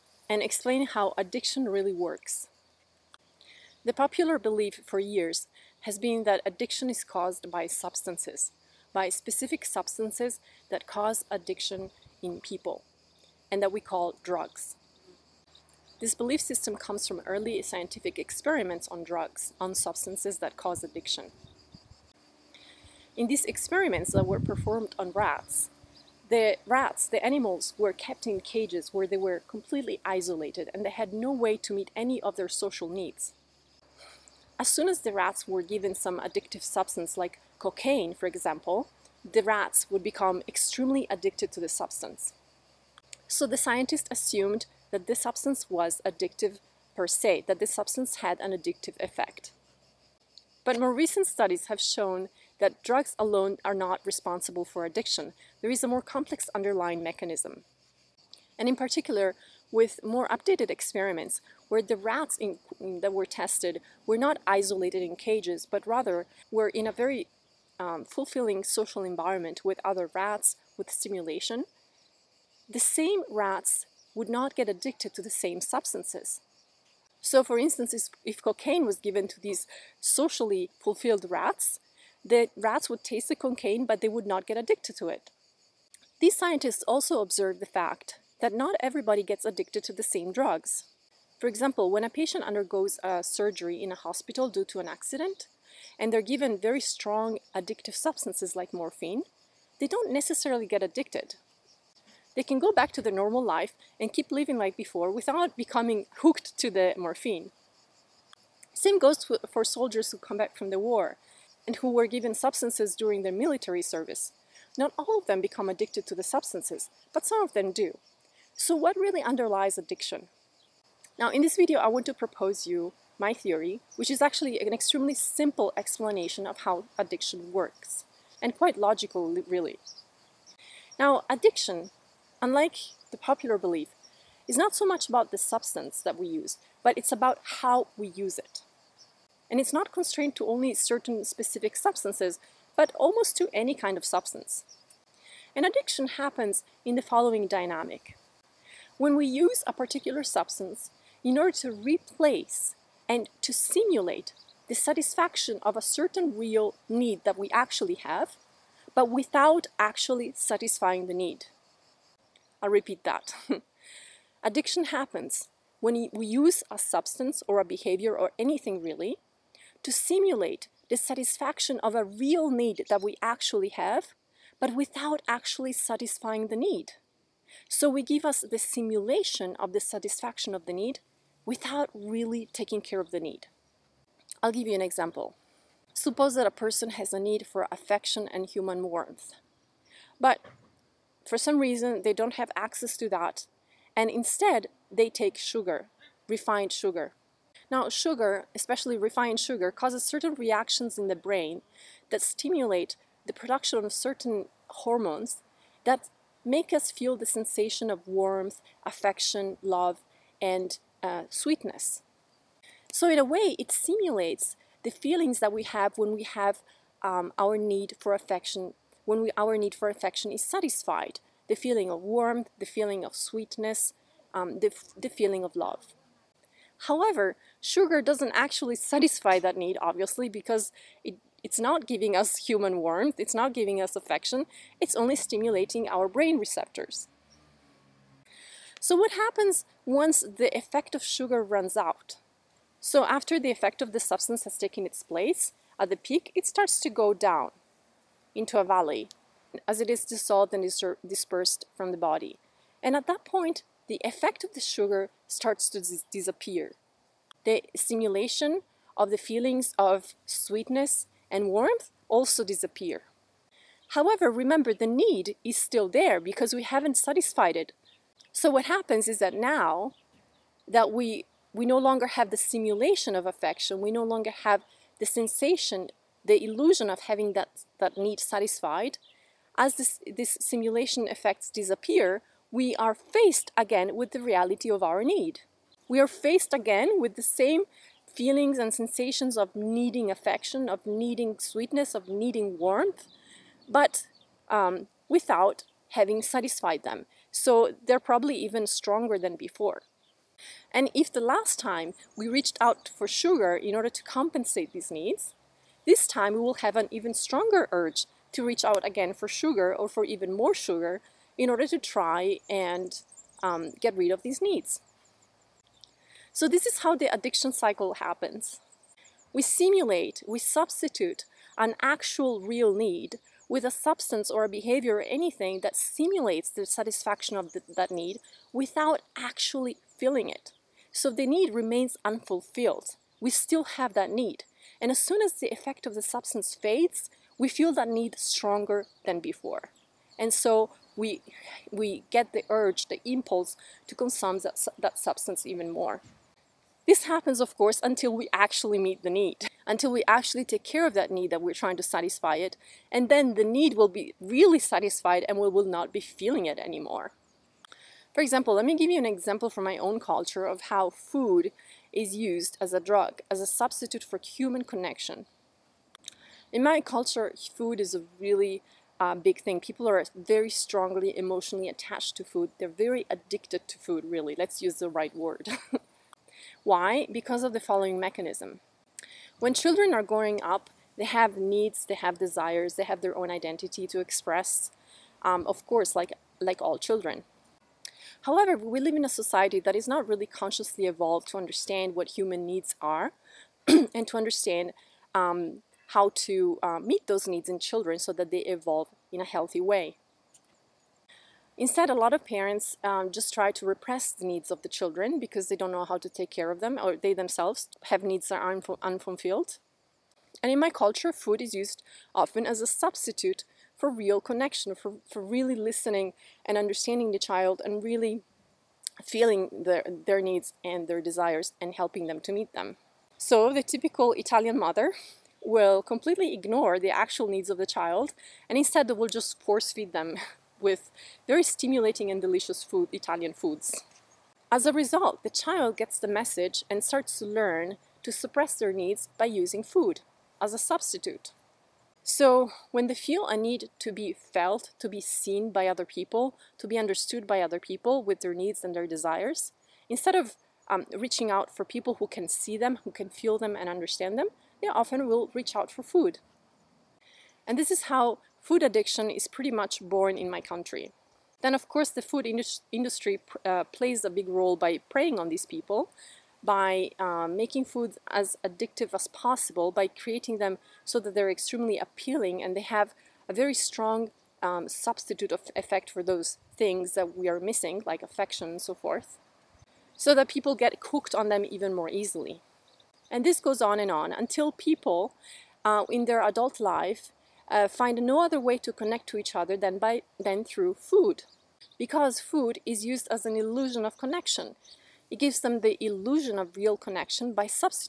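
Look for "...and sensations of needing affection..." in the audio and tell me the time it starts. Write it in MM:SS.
04:48.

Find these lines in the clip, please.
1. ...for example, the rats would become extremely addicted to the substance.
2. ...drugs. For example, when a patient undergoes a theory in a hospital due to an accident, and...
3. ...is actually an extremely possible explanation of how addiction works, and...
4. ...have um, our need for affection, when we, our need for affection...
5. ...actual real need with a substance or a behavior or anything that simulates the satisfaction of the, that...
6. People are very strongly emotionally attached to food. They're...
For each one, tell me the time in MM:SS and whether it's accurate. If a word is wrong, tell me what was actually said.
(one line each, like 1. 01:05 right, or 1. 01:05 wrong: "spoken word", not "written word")
1. 00:38 right
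2. 01:30 wrong: "surgery", not "theory"
3. 02:04 wrong: "simple", not "possible"
4. 03:36 right
5. 05:21 right
6. 06:09 right.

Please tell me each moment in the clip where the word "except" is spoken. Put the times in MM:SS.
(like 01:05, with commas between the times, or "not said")
not said.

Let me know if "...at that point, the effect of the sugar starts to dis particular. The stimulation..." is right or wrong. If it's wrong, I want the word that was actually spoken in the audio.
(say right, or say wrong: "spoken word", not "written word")
wrong: "disappear", not "particular".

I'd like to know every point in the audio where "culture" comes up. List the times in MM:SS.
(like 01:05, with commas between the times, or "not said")
05:59, 06:06, 06:50.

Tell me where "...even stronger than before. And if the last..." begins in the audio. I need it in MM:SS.
04:58.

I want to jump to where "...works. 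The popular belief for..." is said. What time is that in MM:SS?
00:01.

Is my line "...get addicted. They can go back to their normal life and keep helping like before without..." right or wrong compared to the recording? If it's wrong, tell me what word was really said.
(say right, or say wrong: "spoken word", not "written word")
wrong: "living", not "helping".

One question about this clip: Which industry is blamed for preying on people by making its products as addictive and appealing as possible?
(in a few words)
the food industry.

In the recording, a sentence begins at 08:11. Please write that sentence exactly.
Because food is used as an illusion of connection.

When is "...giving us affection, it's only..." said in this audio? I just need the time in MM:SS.
03:53.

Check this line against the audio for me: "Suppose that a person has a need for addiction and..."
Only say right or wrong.
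wrong.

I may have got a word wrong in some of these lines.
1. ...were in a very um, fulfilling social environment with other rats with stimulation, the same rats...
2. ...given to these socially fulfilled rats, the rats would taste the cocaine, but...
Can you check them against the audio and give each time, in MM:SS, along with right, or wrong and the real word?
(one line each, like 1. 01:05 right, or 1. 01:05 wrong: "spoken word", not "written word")
1. 01:06 right
2. 01:18 right.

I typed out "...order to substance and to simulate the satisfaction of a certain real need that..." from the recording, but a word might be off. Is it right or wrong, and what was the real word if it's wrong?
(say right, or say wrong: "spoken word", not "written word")
wrong: "replace", not "substance".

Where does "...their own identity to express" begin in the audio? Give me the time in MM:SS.
06:23.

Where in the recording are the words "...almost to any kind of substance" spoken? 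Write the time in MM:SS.
02:22.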